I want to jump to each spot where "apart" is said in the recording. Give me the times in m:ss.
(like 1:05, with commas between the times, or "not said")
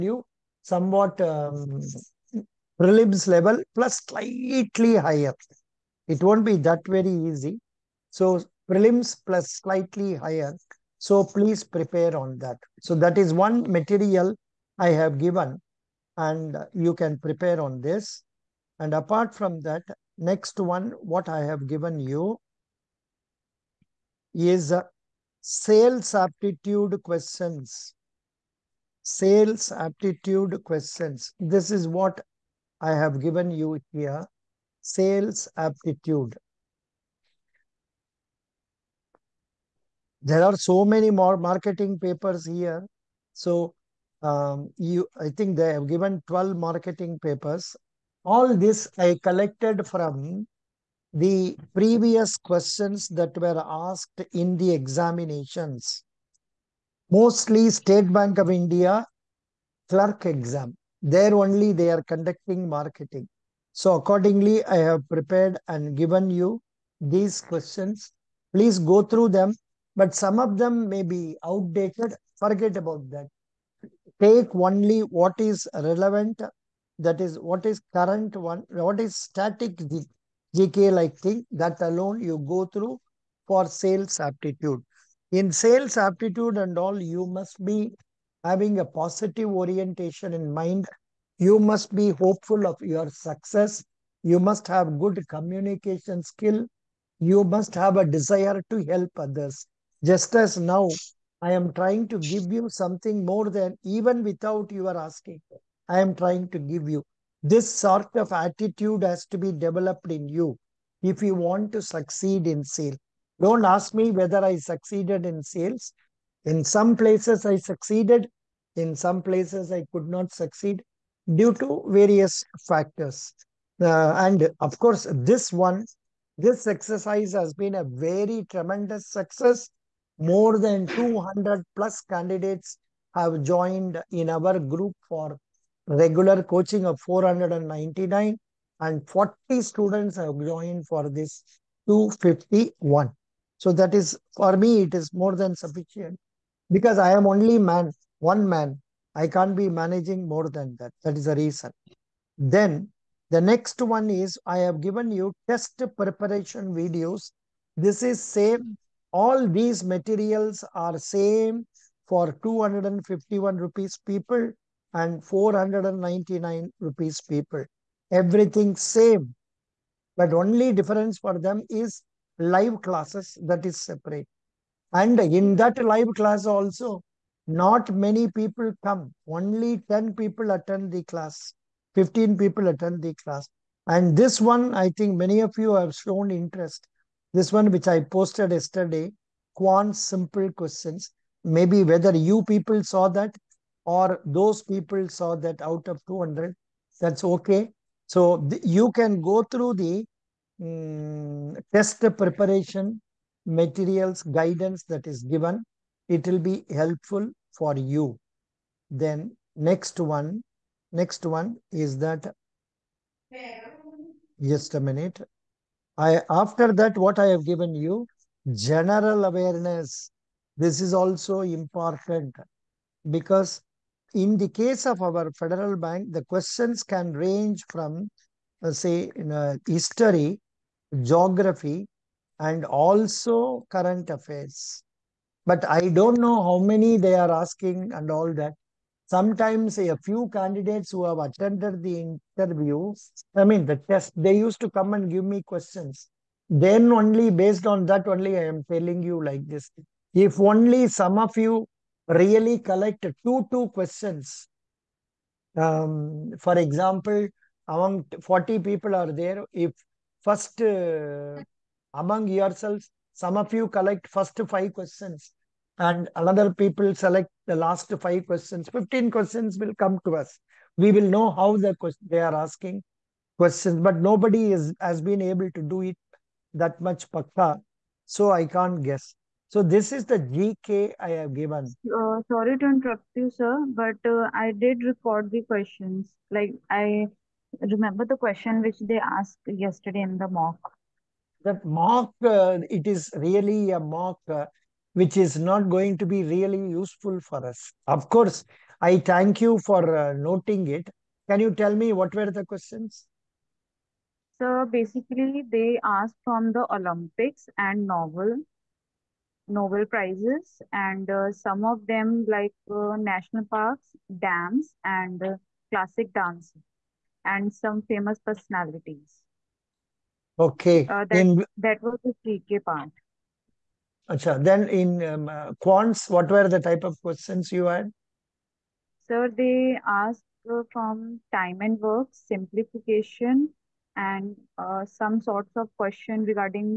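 0:18.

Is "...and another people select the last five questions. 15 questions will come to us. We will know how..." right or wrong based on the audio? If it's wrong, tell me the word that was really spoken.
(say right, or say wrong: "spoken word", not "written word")
right.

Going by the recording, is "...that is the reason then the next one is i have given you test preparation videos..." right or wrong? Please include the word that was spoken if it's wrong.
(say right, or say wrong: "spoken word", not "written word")
right.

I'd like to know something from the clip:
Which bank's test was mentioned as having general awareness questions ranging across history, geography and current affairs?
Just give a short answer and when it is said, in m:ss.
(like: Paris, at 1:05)
Federal Bank, at 3:45.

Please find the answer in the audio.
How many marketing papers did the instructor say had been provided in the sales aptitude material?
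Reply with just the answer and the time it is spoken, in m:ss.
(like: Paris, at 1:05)
12, at 0:46.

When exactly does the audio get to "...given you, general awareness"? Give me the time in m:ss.
3:37.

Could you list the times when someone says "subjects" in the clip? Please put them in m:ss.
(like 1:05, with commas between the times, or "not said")
not said.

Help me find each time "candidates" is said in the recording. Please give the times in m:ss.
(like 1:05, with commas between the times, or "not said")
2:12, 4:00.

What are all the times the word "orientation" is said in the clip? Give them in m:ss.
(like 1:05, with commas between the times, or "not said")
1:29.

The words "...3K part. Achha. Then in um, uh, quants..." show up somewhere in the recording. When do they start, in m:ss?
5:22.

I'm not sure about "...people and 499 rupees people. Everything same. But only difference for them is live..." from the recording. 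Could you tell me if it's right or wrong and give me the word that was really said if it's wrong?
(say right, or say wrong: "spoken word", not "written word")
right.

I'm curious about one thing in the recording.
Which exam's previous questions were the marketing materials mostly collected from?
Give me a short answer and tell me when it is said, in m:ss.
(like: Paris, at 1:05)
State Bank of India clerk, at 0:57.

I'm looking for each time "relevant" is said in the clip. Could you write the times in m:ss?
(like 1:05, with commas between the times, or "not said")
1:15.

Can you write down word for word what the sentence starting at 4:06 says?
Then only based on that, only I am telling you like this.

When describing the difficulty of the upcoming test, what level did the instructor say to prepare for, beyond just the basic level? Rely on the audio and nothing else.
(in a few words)
prelims plus slightly higher.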